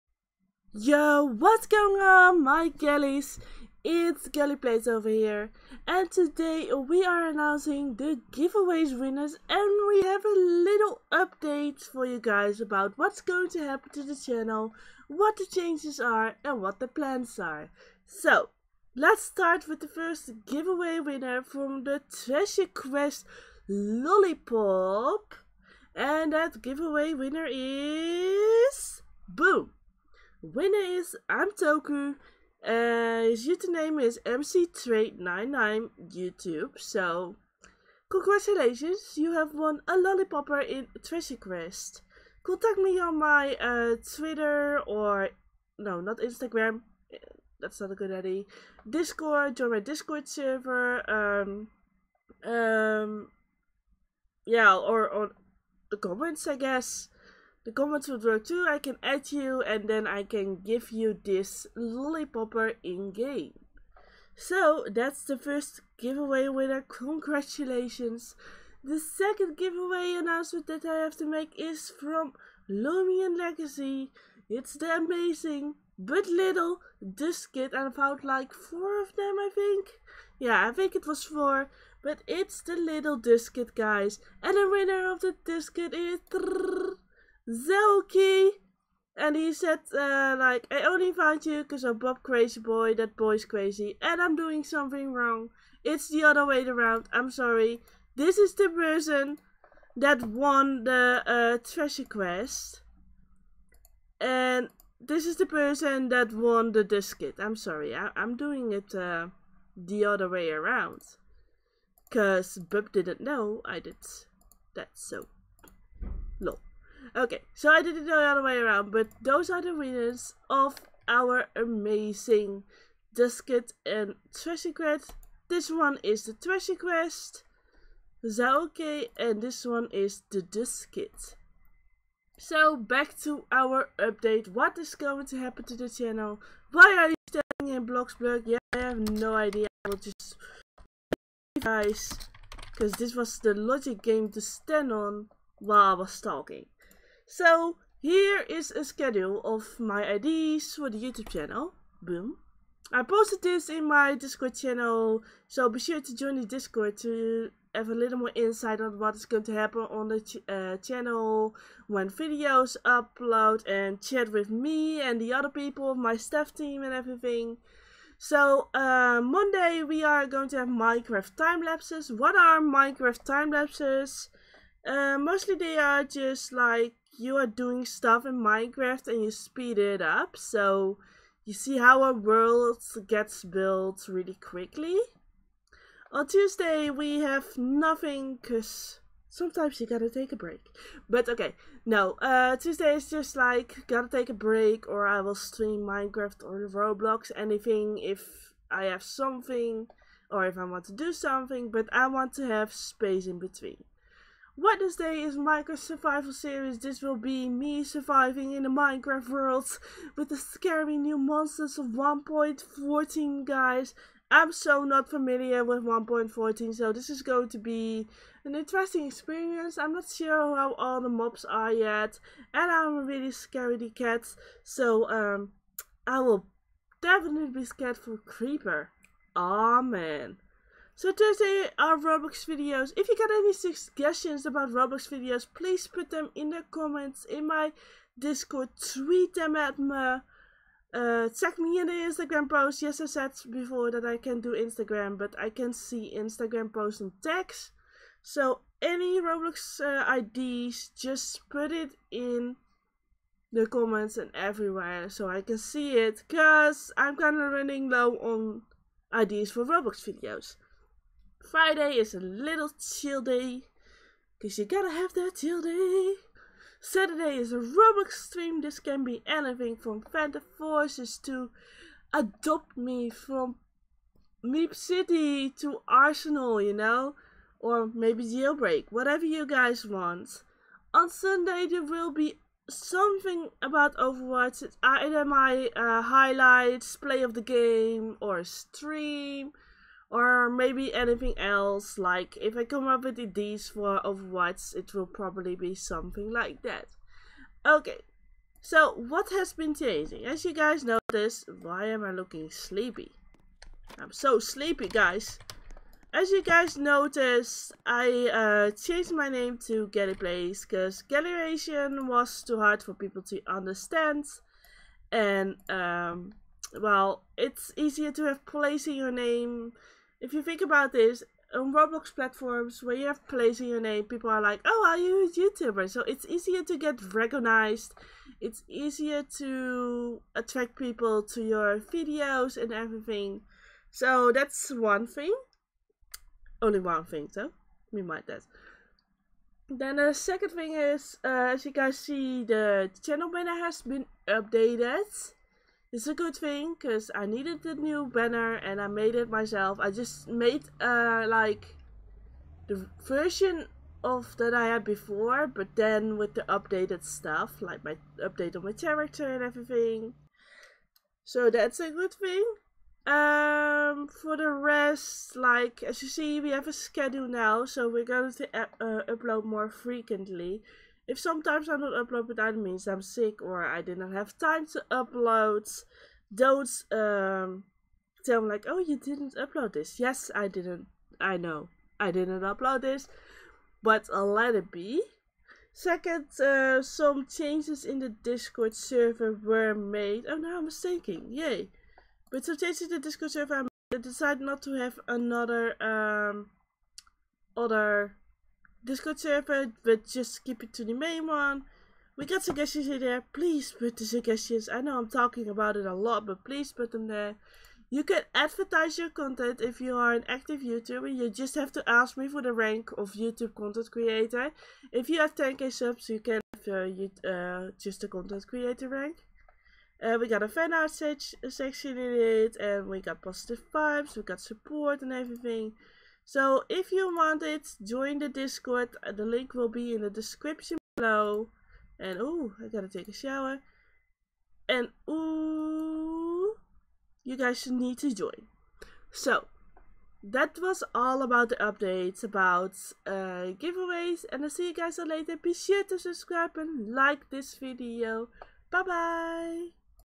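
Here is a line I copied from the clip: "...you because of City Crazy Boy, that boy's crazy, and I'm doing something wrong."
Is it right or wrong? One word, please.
wrong.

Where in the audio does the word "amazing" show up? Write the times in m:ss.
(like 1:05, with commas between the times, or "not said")
1:14, 2:01.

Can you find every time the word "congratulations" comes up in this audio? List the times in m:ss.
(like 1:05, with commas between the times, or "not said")
0:38, 1:06.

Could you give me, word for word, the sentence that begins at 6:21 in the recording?
I didn't upload this, but I'll let it be.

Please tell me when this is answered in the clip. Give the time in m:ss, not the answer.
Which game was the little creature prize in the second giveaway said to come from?
1:12.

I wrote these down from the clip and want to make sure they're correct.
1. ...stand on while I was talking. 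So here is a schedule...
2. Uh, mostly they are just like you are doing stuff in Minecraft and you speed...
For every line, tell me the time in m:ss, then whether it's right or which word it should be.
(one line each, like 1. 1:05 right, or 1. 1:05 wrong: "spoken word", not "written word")
1. 2:24 right
2. 2:54 right.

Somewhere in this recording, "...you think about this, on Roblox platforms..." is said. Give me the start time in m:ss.
5:20.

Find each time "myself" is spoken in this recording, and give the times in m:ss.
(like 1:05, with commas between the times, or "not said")
5:49.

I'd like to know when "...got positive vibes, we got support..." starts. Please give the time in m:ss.
7:03.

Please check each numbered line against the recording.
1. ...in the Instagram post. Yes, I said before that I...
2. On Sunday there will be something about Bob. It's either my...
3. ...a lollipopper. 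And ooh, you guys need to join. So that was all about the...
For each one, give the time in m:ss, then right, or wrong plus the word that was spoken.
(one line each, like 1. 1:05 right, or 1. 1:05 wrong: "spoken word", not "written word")
1. 4:01 right
2. 4:40 wrong: "Overwatch", not "Bob"
3. 7:13 wrong: "shower", not "lollipopper".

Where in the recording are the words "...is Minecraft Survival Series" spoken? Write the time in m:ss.
3:25.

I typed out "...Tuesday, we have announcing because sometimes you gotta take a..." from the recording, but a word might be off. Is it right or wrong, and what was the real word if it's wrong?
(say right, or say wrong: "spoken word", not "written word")
wrong: "nothing", not "announcing".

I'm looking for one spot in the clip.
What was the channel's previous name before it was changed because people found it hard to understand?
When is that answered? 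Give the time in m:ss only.
5:11.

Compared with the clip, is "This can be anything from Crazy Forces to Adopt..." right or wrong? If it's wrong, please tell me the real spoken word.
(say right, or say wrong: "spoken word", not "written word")
wrong: "Phantom", not "Crazy".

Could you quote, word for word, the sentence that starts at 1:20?
Yeah, I think it was four.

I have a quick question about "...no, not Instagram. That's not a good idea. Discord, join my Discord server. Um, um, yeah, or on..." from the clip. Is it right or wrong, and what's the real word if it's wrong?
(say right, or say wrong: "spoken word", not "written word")
right.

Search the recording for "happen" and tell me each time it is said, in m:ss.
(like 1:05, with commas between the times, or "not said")
0:13, 2:15, 2:39.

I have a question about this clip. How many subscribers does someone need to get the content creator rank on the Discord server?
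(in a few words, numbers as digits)
10k.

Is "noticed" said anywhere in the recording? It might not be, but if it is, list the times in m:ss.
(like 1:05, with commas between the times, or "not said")
5:00, 5:06.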